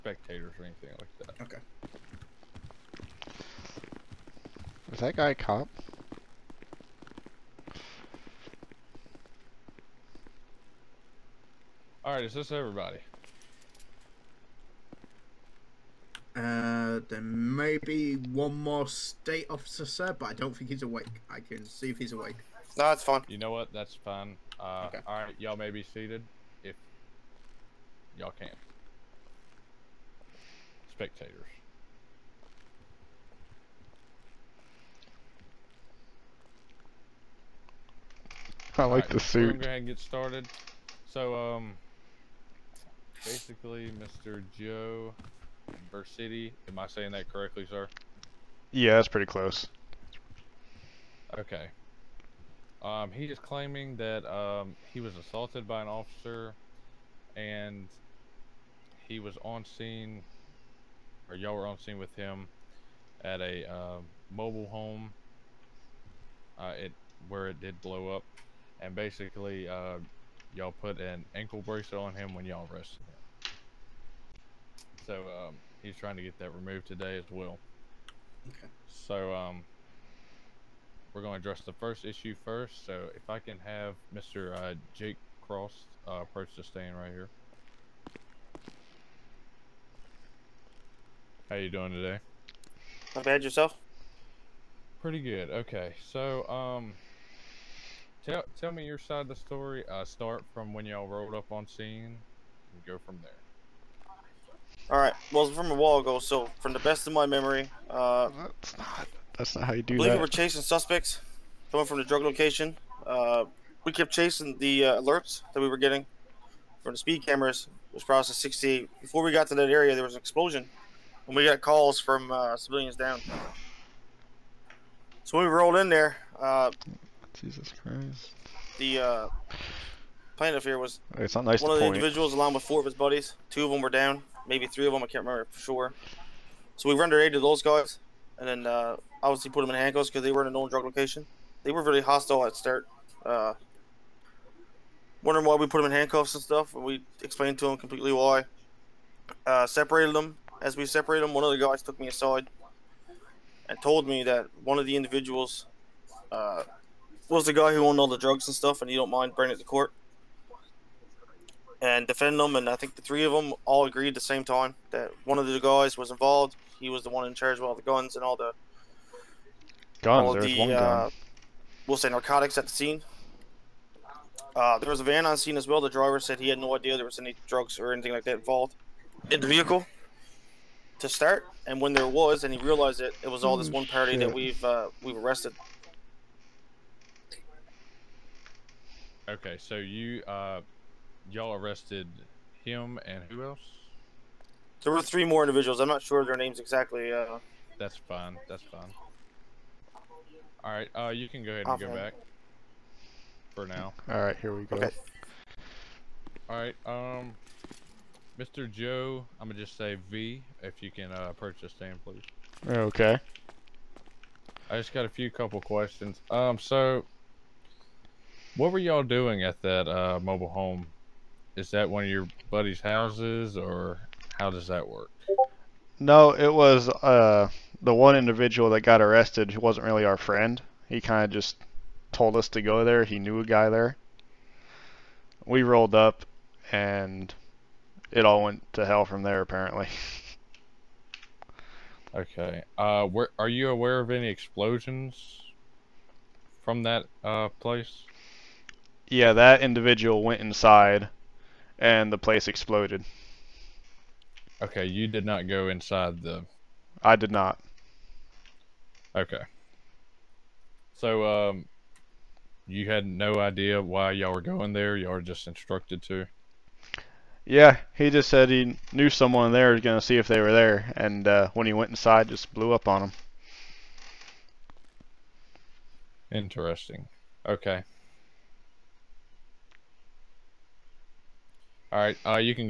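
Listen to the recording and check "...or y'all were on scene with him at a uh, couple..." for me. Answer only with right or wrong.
wrong.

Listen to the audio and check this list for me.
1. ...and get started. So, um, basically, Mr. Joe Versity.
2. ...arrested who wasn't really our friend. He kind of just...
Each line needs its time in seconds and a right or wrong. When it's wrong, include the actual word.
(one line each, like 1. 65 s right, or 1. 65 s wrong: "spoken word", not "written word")
1. 39 s right
2. 229 s right.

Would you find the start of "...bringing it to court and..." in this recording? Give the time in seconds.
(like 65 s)
159 s.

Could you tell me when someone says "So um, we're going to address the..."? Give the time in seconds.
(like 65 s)
78 s.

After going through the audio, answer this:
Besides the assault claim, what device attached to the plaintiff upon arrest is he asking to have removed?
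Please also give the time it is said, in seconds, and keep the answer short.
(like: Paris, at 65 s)
ankle bracelet, at 71 s.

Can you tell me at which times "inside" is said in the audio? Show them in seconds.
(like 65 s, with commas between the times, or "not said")
250 s, 255 s, 271 s.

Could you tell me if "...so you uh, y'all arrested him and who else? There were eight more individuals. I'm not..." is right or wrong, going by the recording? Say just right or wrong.
wrong.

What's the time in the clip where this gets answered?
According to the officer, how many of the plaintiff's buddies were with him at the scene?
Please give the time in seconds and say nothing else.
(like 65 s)
132 s.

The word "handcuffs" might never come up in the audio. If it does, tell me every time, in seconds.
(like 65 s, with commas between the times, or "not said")
139 s, 145 s.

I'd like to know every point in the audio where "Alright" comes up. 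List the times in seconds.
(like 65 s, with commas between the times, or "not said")
104 s, 281 s.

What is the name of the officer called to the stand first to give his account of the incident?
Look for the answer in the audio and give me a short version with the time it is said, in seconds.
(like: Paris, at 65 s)
Jake Cross, at 84 s.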